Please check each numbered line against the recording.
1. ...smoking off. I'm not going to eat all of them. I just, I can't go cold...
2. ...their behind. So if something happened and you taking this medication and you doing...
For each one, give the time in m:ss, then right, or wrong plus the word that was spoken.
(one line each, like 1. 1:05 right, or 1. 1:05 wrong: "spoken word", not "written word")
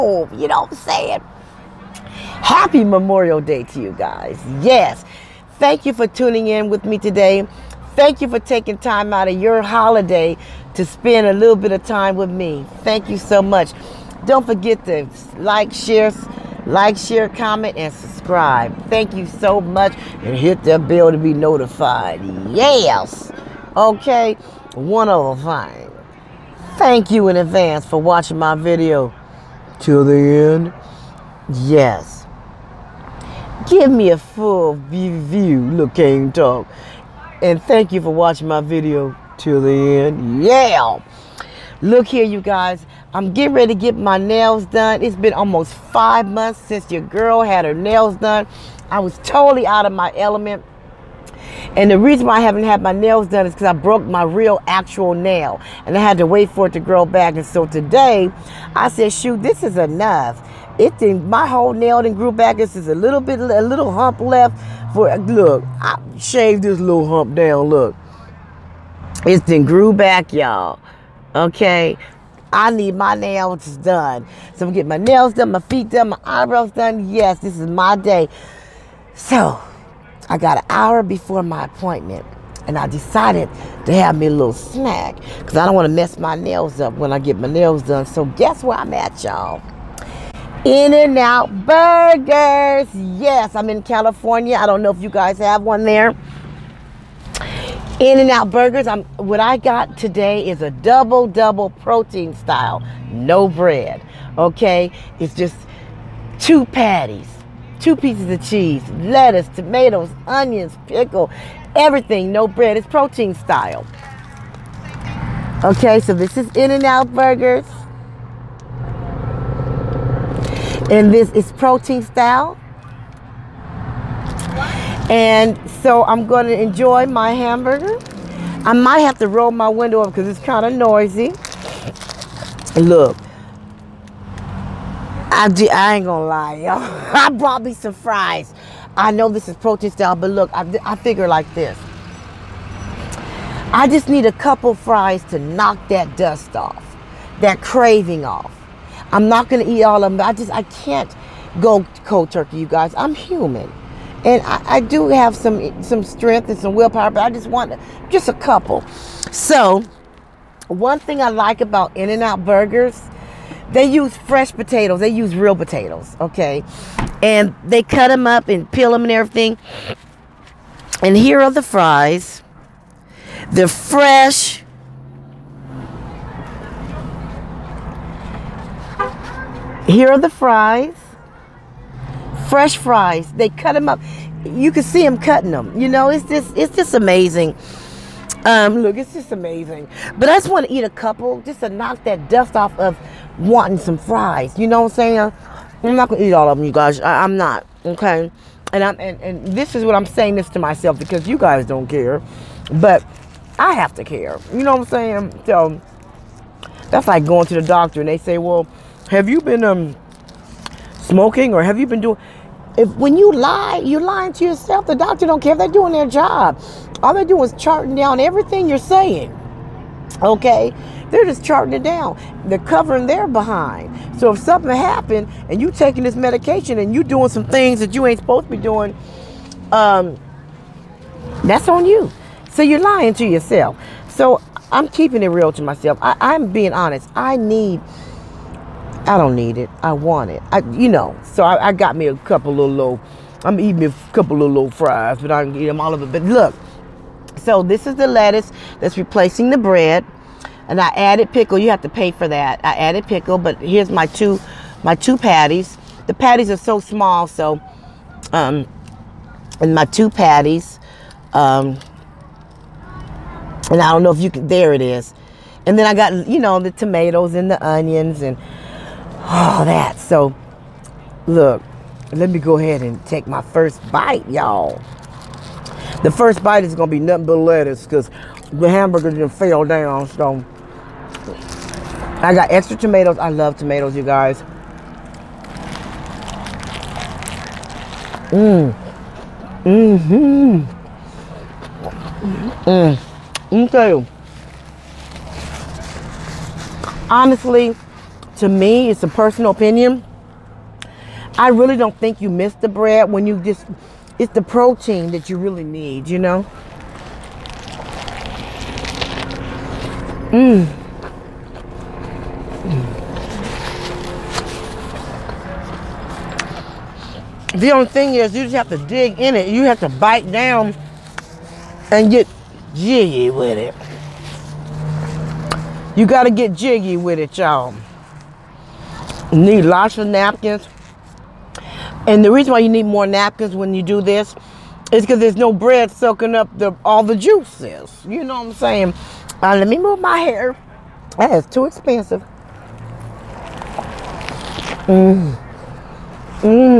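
1. 2:27 wrong: "craving", not "smoking"
2. 3:43 right.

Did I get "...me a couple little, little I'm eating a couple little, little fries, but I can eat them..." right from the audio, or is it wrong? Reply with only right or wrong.
right.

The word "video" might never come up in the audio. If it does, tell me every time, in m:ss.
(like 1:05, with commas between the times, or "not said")
0:28, 0:38.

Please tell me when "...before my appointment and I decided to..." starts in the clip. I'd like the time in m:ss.
1:21.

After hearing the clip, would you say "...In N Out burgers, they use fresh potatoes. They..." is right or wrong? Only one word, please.
right.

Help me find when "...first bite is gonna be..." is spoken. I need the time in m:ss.
4:36.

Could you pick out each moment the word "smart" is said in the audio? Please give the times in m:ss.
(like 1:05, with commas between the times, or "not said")
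not said.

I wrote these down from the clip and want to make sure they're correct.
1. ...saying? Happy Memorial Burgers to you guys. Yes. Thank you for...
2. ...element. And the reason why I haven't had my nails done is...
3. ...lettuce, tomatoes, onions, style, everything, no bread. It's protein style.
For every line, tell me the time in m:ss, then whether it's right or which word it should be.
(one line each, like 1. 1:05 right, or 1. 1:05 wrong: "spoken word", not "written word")
1. 0:00 wrong: "Day", not "Burgers"
2. 0:50 right
3. 1:49 wrong: "pickle", not "style".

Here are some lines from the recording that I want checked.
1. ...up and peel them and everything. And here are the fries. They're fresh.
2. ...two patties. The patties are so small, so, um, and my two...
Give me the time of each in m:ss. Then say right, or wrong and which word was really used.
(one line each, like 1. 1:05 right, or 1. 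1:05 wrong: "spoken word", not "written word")
1. 2:48 right
2. 4:14 right.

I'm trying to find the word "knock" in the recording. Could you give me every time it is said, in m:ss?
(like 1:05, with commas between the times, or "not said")
2:25, 3:11.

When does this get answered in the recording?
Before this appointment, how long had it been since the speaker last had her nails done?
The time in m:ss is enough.
0:45.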